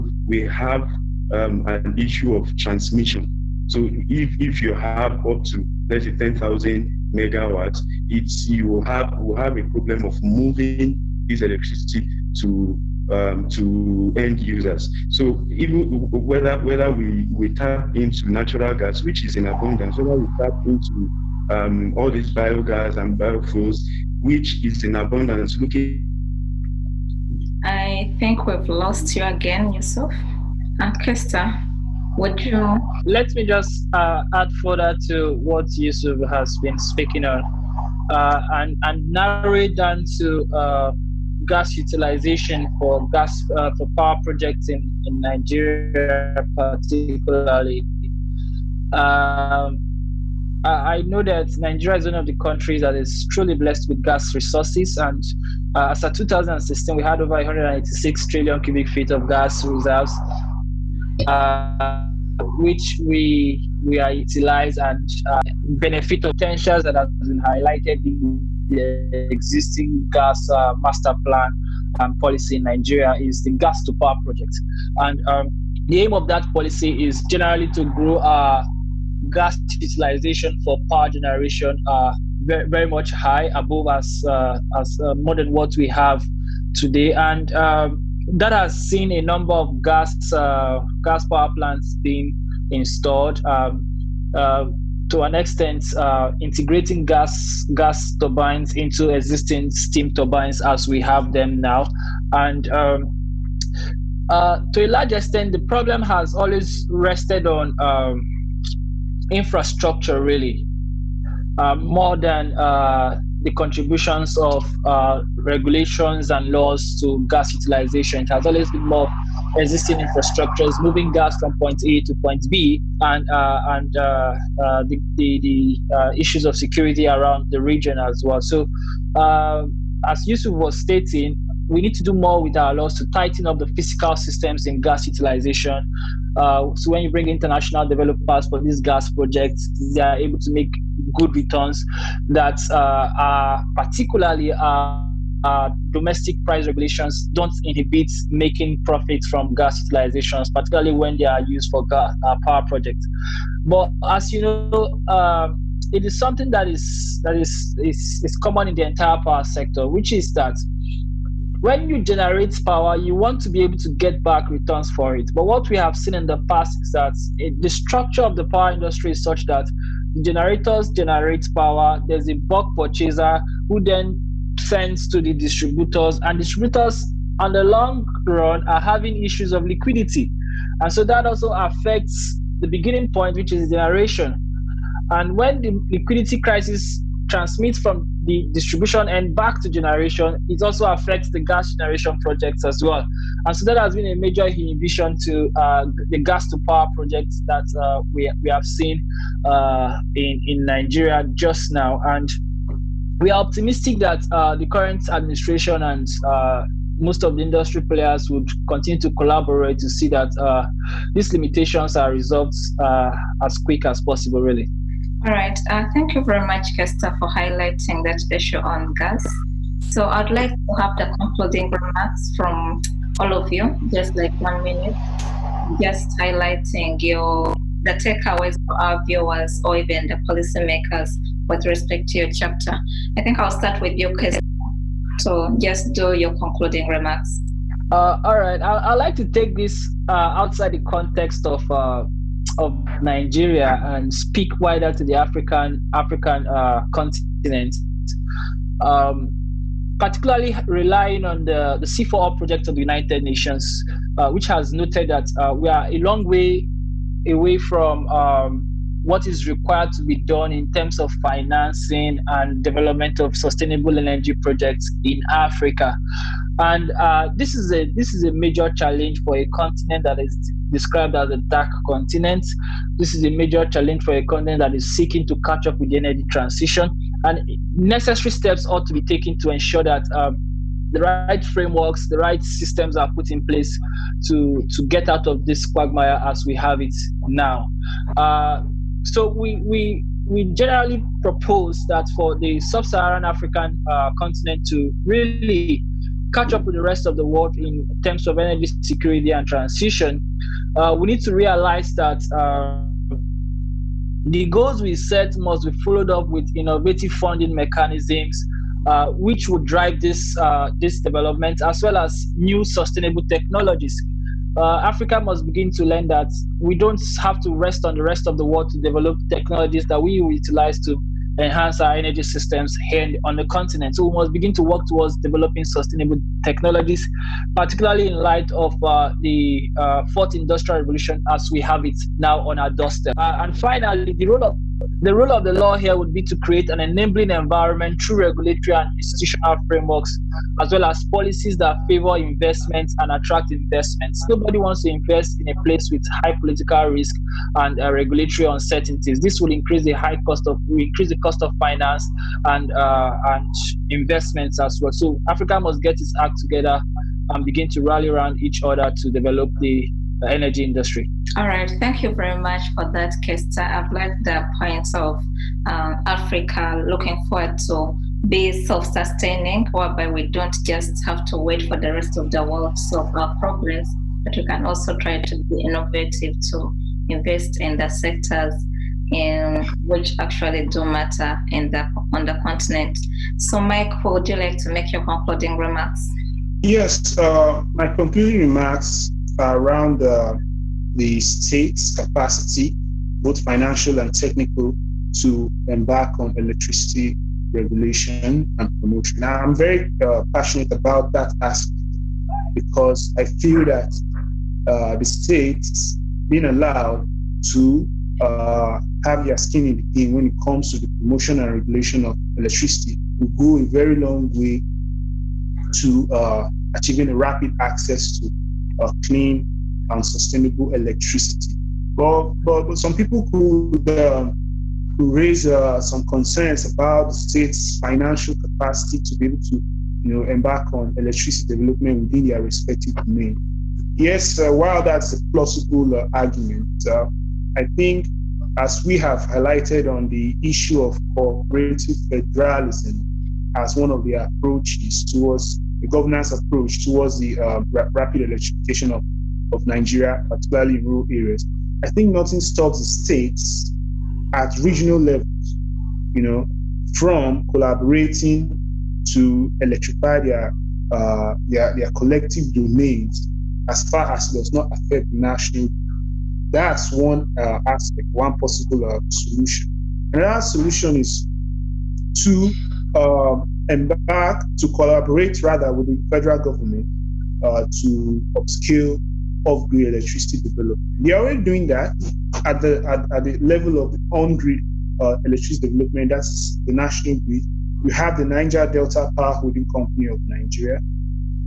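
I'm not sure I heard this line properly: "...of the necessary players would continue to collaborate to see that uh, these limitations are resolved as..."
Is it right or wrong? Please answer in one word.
wrong.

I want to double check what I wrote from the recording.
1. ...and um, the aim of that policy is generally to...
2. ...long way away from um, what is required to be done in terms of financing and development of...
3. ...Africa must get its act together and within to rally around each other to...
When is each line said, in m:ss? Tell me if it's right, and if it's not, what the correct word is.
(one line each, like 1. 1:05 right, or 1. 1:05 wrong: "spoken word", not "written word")
1. 1:14 right
2. 4:15 right
3. 5:55 wrong: "begin", not "within".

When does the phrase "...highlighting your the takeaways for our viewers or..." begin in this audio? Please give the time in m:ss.
3:46.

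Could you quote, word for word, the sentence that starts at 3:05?
And when the liquidity crisis transmits from the distribution end back to generation, it also affects the gas generation projects as well.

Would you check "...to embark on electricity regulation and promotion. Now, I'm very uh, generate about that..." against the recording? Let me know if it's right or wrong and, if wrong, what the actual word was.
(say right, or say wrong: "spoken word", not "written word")
wrong: "passionate", not "generate".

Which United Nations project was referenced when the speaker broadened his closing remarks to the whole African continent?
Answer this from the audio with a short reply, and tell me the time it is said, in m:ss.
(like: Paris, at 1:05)
C4R project, at 4:11.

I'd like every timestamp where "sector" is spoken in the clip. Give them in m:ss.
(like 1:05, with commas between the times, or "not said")
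2:39, 6:17.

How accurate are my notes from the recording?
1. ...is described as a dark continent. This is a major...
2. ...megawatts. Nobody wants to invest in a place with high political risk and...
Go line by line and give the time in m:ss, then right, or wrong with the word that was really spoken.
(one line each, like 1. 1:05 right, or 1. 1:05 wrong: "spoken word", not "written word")
1. 4:30 right
2. 5:43 wrong: "investments", not "megawatts".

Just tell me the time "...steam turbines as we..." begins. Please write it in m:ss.
1:39.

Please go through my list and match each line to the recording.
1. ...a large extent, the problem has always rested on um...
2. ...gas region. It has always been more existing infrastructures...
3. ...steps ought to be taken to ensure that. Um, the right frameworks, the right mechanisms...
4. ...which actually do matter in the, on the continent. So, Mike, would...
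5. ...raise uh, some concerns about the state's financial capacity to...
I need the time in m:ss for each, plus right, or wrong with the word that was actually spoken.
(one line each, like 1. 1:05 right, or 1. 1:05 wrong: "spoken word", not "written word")
1. 1:44 right
2. 1:57 wrong: "utilization", not "region"
3. 4:38 wrong: "systems", not "mechanisms"
4. 6:19 right
5. 7:04 right.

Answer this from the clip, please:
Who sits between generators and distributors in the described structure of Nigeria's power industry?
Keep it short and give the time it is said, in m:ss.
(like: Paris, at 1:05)
bulk purchaser, at 2:52.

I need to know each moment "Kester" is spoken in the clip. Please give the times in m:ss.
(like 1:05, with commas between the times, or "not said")
0:31, 3:36, 3:54, 6:03.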